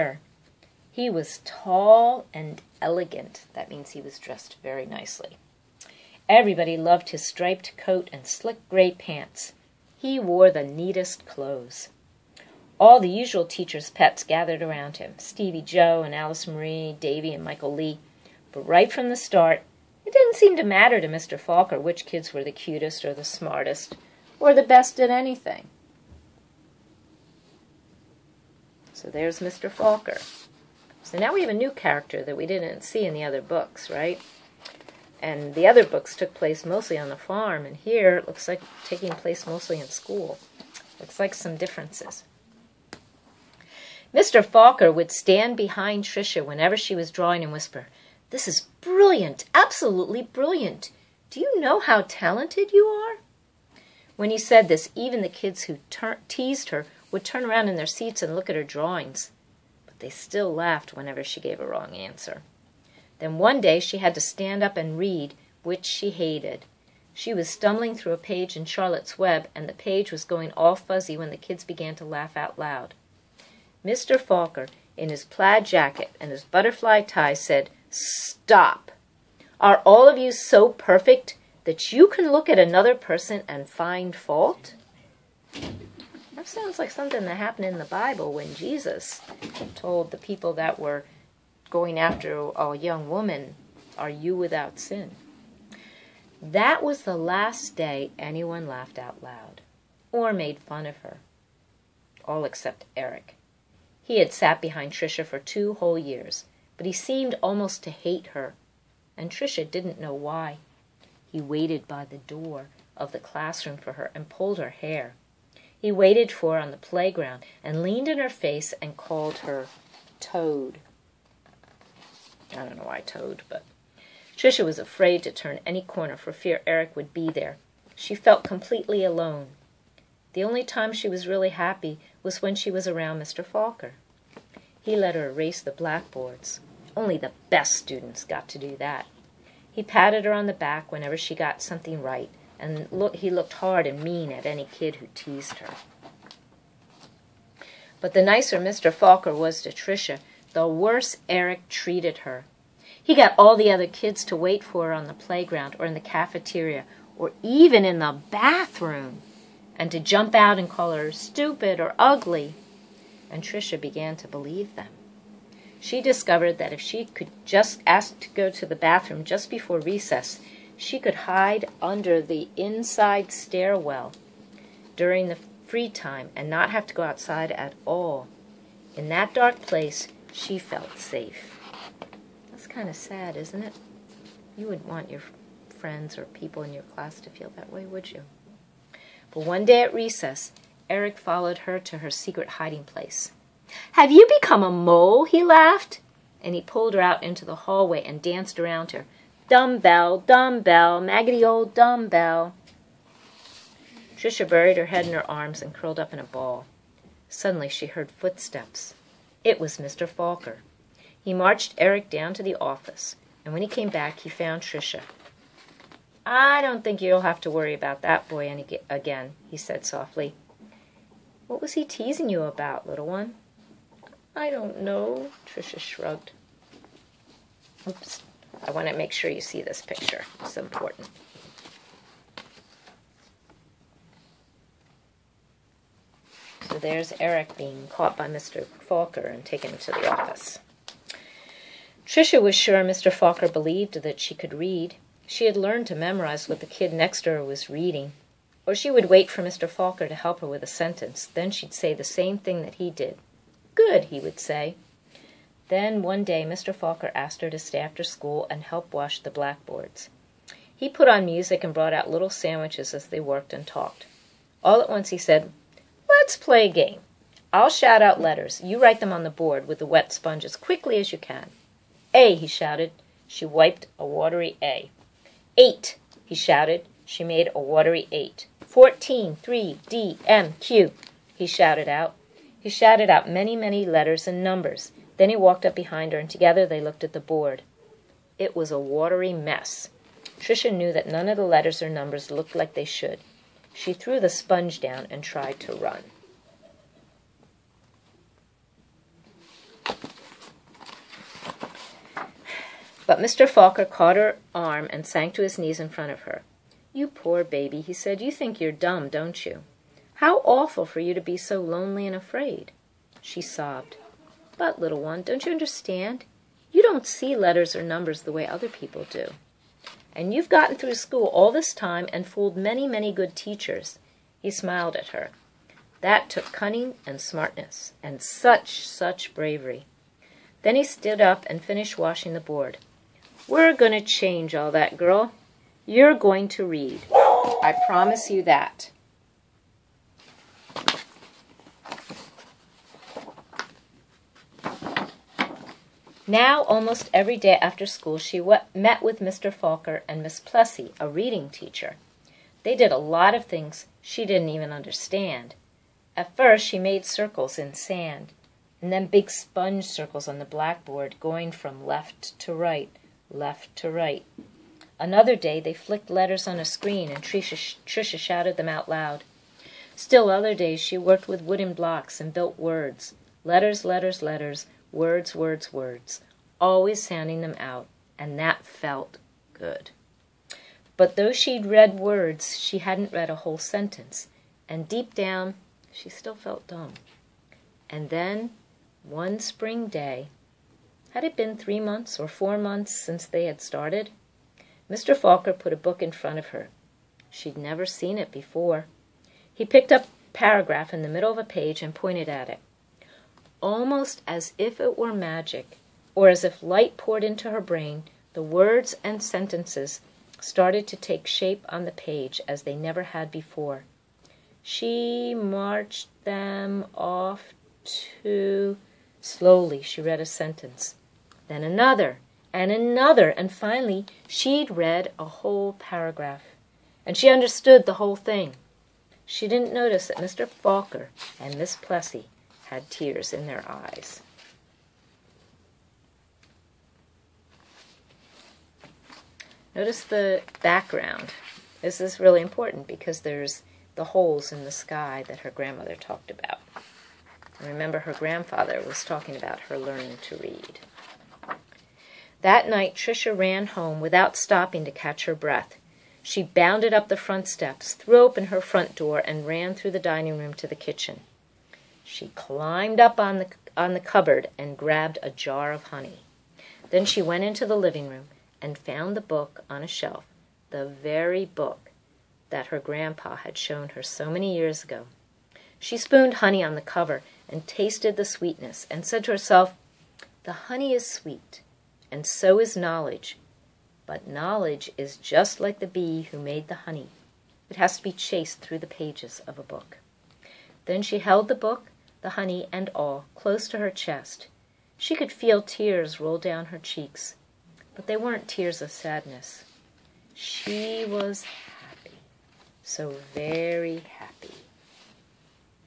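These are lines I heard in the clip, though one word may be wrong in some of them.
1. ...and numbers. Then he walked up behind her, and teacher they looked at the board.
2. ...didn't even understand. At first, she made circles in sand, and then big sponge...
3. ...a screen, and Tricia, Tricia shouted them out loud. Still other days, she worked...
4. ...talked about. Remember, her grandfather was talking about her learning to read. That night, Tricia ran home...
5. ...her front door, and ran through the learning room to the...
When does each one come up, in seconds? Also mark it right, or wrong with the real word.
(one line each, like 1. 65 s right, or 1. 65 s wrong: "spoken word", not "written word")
1. 284 s wrong: "together", not "teacher"
2. 354 s right
3. 366 s right
4. 445 s right
5. 458 s wrong: "dining", not "learning".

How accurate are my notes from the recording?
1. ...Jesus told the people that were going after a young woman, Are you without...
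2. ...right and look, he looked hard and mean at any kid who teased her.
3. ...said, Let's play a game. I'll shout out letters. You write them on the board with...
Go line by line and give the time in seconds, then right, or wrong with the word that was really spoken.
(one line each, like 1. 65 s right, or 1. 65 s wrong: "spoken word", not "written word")
1. 88 s right
2. 142 s right
3. 265 s right.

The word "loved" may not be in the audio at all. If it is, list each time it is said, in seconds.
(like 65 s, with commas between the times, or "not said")
6 s.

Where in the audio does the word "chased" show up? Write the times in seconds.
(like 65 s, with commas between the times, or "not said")
488 s.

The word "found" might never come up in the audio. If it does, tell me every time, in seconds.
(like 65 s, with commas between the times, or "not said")
214 s, 468 s.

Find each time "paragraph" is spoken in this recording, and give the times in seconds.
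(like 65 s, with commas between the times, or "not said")
400 s, 425 s.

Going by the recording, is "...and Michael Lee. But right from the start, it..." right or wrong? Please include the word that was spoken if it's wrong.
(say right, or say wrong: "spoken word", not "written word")
right.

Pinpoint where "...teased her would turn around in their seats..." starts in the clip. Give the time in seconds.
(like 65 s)
56 s.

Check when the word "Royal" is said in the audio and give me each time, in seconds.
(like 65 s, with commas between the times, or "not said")
not said.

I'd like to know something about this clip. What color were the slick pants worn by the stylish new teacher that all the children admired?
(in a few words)
Gray.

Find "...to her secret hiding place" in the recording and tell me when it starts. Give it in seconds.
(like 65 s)
191 s.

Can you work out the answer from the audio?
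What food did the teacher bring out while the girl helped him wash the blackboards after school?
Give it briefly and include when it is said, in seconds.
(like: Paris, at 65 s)
Little sandwiches, at 262 s.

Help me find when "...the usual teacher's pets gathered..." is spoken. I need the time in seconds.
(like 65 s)
12 s.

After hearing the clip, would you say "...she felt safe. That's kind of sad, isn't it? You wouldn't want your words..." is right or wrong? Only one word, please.
wrong.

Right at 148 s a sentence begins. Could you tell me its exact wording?
Falker was to Tricia, the worse Eric treated her.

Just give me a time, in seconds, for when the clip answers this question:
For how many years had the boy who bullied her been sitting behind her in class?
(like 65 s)
105 s.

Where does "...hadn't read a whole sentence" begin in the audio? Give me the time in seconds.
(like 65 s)
382 s.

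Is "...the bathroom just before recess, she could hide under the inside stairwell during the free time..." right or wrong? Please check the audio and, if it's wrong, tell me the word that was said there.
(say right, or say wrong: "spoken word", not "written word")
right.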